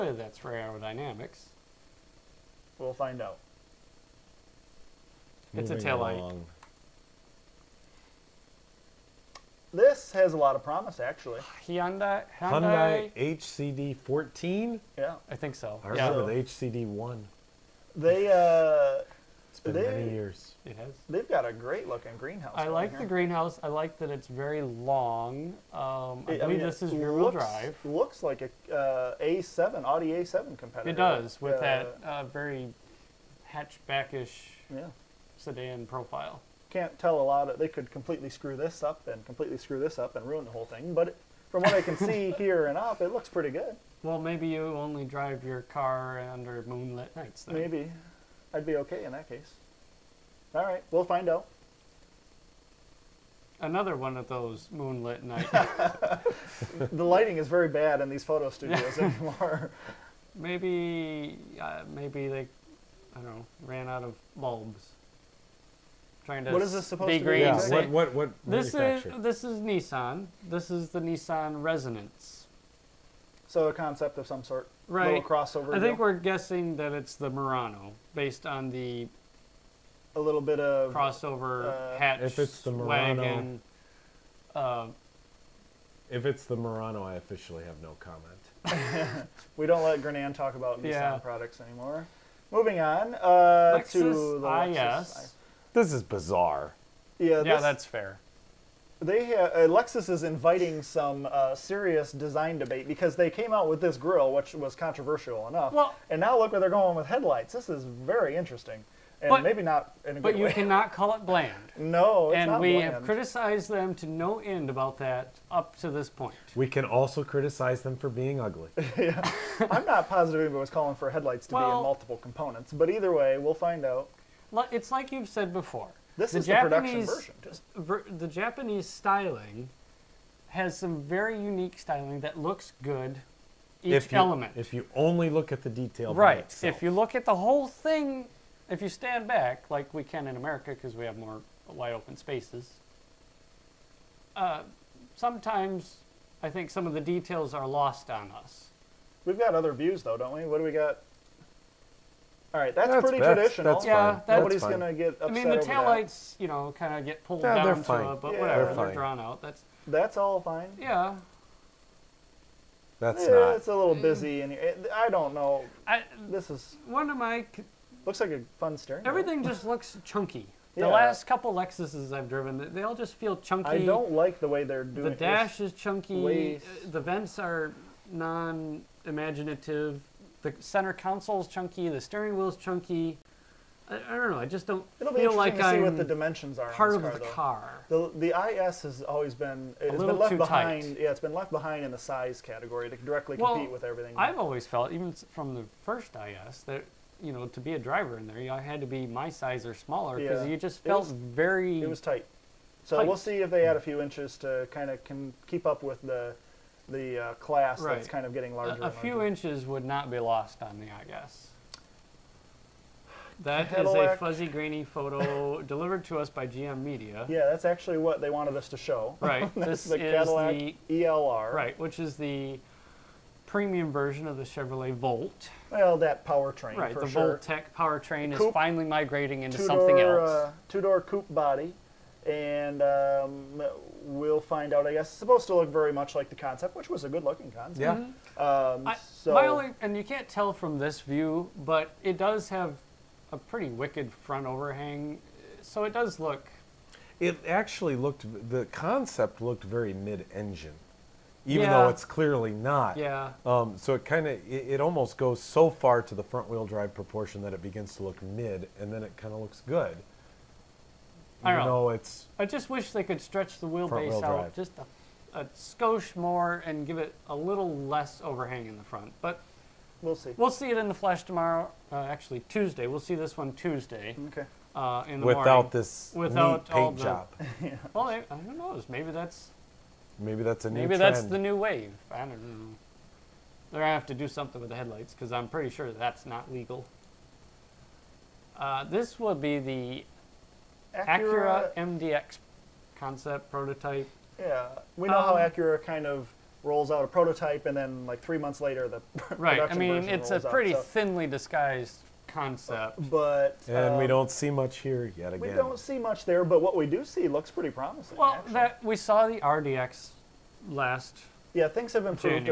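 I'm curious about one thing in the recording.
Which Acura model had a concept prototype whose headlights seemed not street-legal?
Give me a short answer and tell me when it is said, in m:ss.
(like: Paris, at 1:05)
MDX, at 4:51.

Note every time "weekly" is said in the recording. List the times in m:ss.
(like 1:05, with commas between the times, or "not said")
not said.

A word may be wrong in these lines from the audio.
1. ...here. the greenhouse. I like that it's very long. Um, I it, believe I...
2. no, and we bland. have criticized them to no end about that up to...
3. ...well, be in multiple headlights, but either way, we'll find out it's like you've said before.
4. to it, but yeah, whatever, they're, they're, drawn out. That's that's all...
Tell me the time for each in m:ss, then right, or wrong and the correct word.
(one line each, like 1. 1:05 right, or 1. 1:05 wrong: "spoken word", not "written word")
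1. 0:22 right
2. 1:51 right
3. 2:01 wrong: "components", not "headlights"
4. 2:38 right.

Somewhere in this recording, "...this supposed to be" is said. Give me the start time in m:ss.
1:06.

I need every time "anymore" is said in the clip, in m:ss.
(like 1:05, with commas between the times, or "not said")
0:58, 1:31.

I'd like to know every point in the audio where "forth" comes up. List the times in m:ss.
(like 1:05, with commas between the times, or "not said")
not said.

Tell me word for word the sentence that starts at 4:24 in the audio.
just a, a skosh more and give it a little less overhang in the front.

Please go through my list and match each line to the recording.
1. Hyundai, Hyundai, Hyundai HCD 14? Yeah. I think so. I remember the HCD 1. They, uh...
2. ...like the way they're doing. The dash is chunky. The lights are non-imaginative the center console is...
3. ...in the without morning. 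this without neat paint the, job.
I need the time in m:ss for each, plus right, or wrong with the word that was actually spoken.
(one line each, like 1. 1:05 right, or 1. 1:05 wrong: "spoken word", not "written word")
1. 0:11 right
2. 2:54 wrong: "vents", not "lights"
3. 4:35 right.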